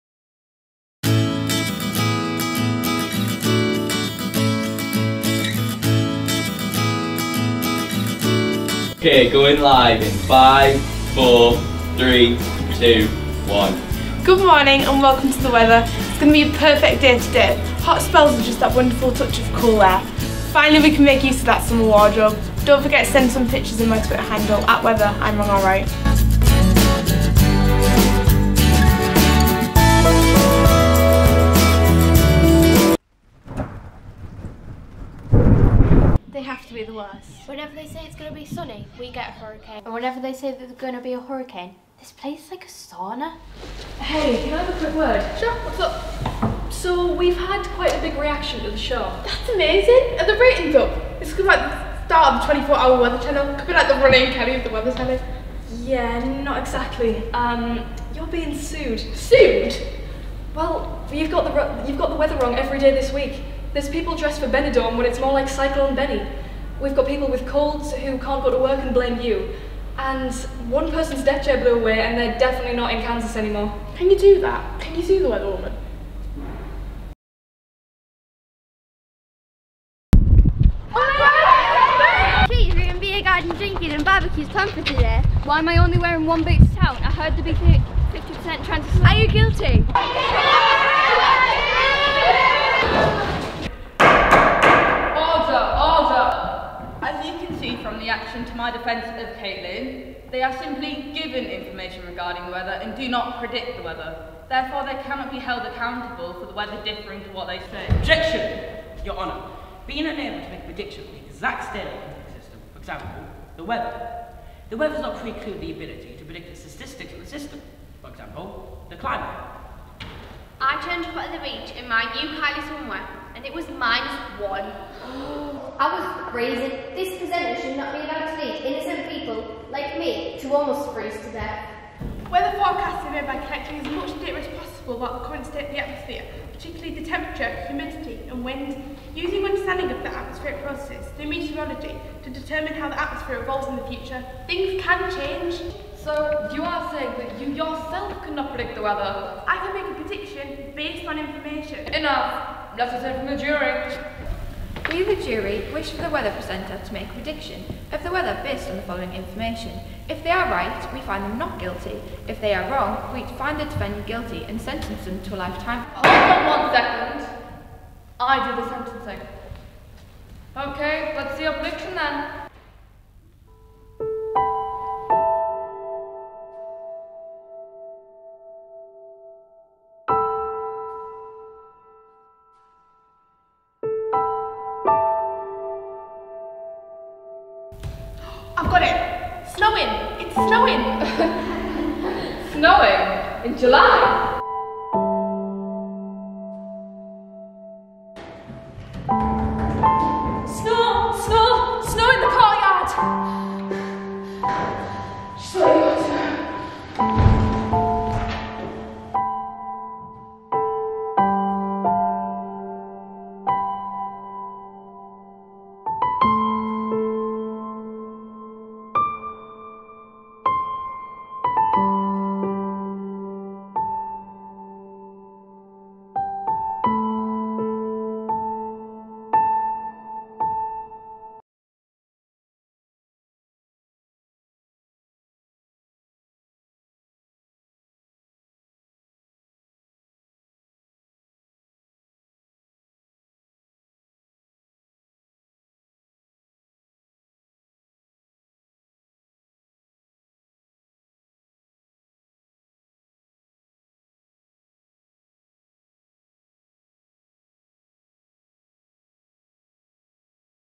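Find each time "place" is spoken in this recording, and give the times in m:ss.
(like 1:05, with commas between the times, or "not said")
0:42.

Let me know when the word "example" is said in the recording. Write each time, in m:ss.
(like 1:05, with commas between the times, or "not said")
1:52, 1:58.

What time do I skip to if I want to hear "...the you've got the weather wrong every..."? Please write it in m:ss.
1:01.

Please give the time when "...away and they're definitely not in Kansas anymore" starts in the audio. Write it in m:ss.
1:11.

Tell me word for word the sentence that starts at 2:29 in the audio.
I can make a prediction based on information.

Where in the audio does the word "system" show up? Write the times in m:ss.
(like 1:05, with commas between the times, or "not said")
1:52, 1:57.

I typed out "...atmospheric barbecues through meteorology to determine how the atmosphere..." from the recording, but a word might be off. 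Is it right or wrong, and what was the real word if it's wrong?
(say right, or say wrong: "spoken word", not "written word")
wrong: "processes", not "barbecues".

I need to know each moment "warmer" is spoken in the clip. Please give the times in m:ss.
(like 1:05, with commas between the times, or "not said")
not said.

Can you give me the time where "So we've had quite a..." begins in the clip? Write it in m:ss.
0:46.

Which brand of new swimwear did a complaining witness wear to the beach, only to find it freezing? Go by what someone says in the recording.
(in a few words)
Kylie.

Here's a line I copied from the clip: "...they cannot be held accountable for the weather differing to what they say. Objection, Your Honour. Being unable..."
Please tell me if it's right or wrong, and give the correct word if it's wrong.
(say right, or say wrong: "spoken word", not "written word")
right.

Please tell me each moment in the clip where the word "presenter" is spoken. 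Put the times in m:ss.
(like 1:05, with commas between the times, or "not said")
2:07, 2:36.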